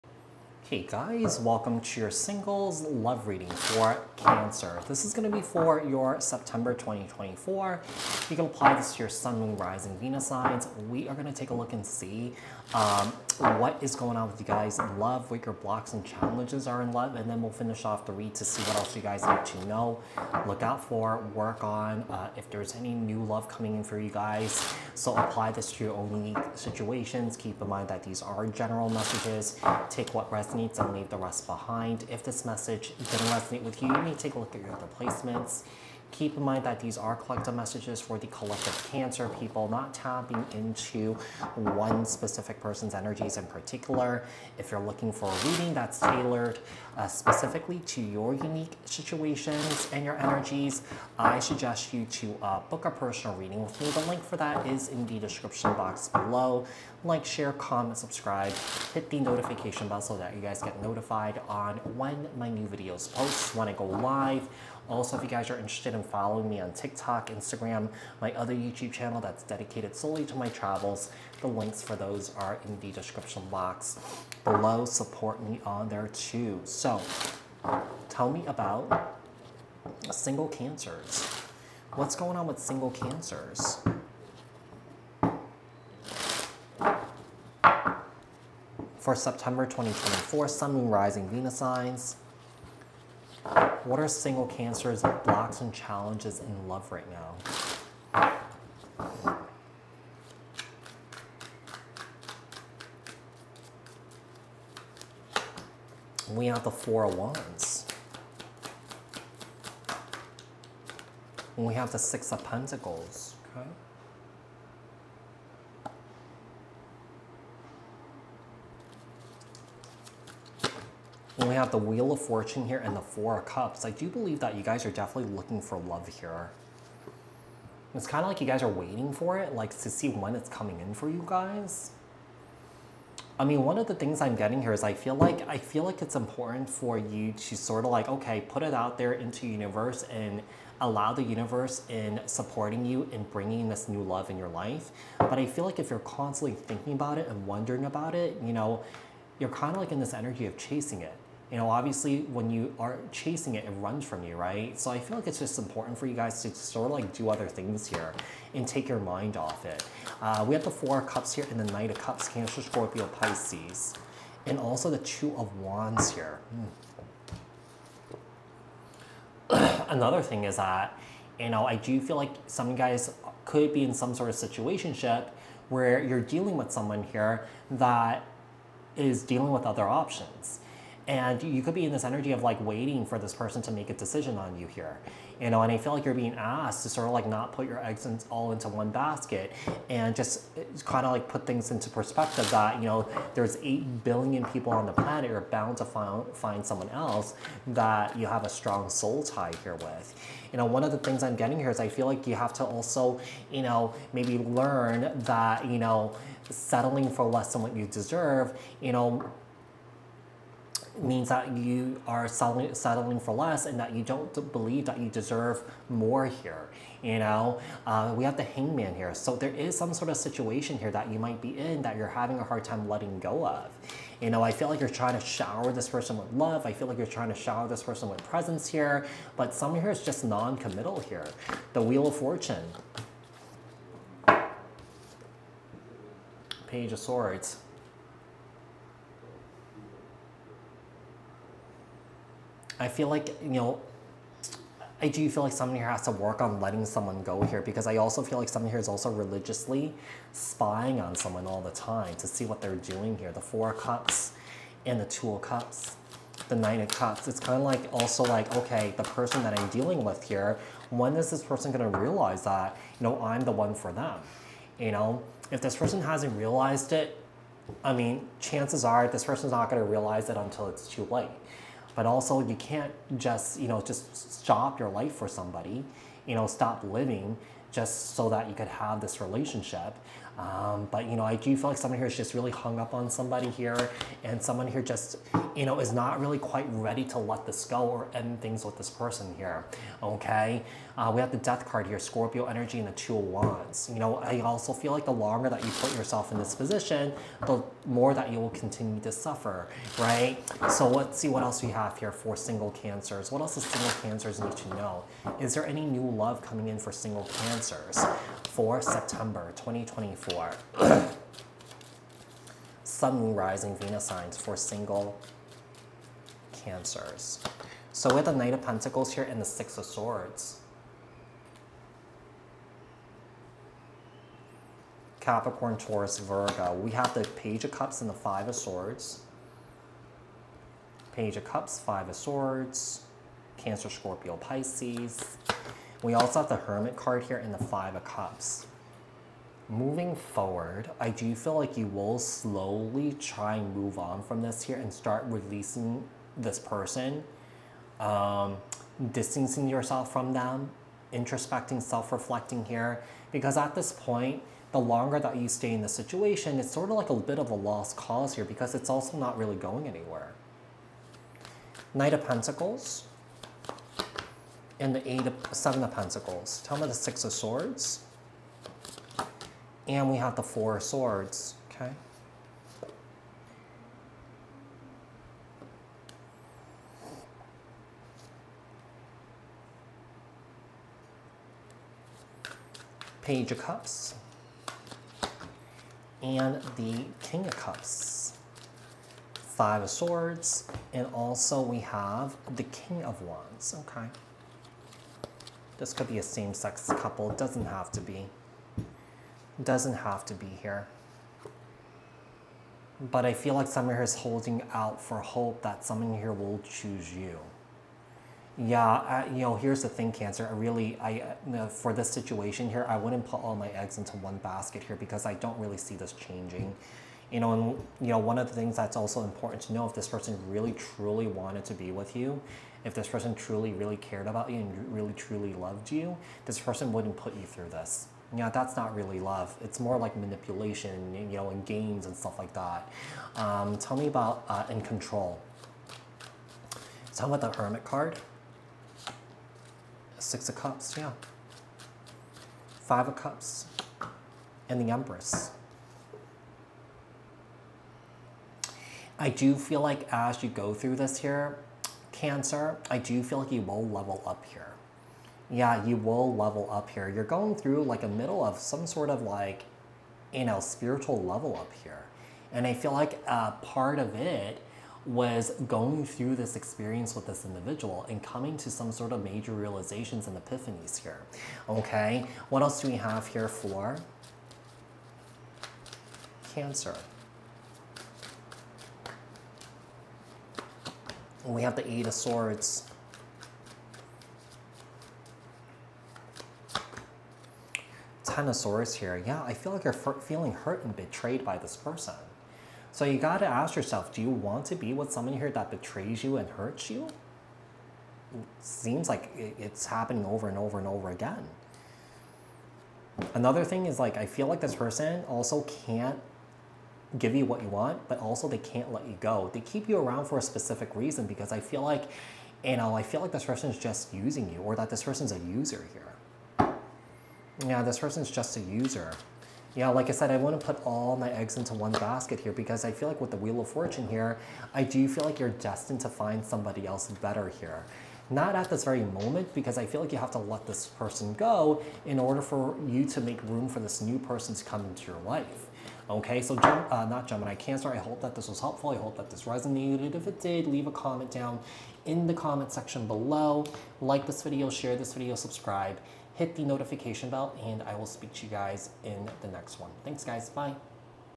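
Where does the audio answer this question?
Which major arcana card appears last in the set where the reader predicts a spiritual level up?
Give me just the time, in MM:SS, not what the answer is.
07:24.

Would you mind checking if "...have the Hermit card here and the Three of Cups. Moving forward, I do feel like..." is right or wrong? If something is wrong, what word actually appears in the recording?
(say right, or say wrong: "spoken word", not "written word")
wrong: "Five", not "Three".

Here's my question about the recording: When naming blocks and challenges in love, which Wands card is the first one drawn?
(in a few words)
Four of Wands.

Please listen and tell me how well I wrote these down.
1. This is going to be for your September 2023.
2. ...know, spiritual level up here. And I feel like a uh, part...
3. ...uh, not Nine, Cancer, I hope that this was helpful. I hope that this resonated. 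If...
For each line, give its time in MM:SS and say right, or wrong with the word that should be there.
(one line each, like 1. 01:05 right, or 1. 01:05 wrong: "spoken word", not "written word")
1. 00:04 wrong: "2024", not "2023"
2. 07:40 right
3. 08:56 wrong: "Gemini", not "Nine".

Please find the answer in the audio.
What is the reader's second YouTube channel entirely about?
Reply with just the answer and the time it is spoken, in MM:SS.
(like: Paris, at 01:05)
Travels, at 01:10.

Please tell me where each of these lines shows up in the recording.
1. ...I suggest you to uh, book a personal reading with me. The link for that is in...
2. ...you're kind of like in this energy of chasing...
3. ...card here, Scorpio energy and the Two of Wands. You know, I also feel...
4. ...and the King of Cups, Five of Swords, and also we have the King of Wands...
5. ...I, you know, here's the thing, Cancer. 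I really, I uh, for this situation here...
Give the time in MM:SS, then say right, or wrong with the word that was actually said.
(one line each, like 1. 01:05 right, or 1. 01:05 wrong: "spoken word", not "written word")
1. 00:51 right
2. 02:29 right
3. 04:51 right
4. 06:26 right
5. 06:48 right.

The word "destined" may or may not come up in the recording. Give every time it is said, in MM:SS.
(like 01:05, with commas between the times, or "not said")
08:45.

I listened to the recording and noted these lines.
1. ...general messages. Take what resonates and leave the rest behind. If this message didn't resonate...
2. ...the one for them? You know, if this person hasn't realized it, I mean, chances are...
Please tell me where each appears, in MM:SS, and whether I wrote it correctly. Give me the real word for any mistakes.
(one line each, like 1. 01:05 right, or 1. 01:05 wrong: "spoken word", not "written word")
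1. 00:28 right
2. 04:23 right.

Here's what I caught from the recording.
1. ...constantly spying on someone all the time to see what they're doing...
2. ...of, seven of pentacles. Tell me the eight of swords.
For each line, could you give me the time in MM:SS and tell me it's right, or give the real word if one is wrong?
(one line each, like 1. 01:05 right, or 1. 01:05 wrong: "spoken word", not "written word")
1. 04:09 wrong: "religiously", not "constantly"
2. 06:05 wrong: "six", not "eight".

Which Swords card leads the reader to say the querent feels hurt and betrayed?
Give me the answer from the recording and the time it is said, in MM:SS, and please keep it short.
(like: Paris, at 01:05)
Ten of Swords, at 08:08.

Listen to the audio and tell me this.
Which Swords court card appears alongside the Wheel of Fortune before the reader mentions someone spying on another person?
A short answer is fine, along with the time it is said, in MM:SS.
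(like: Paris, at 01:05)
Page of Swords, at 03:56.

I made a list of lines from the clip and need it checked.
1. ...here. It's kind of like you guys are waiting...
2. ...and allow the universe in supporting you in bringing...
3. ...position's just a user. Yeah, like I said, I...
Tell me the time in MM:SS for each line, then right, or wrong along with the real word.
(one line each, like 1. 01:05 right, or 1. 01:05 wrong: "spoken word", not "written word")
1. 02:06 right
2. 02:20 right
3. 08:37 wrong: "person", not "position".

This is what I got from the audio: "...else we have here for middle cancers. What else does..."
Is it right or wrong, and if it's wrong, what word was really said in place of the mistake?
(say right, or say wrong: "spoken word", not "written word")
wrong: "single", not "middle".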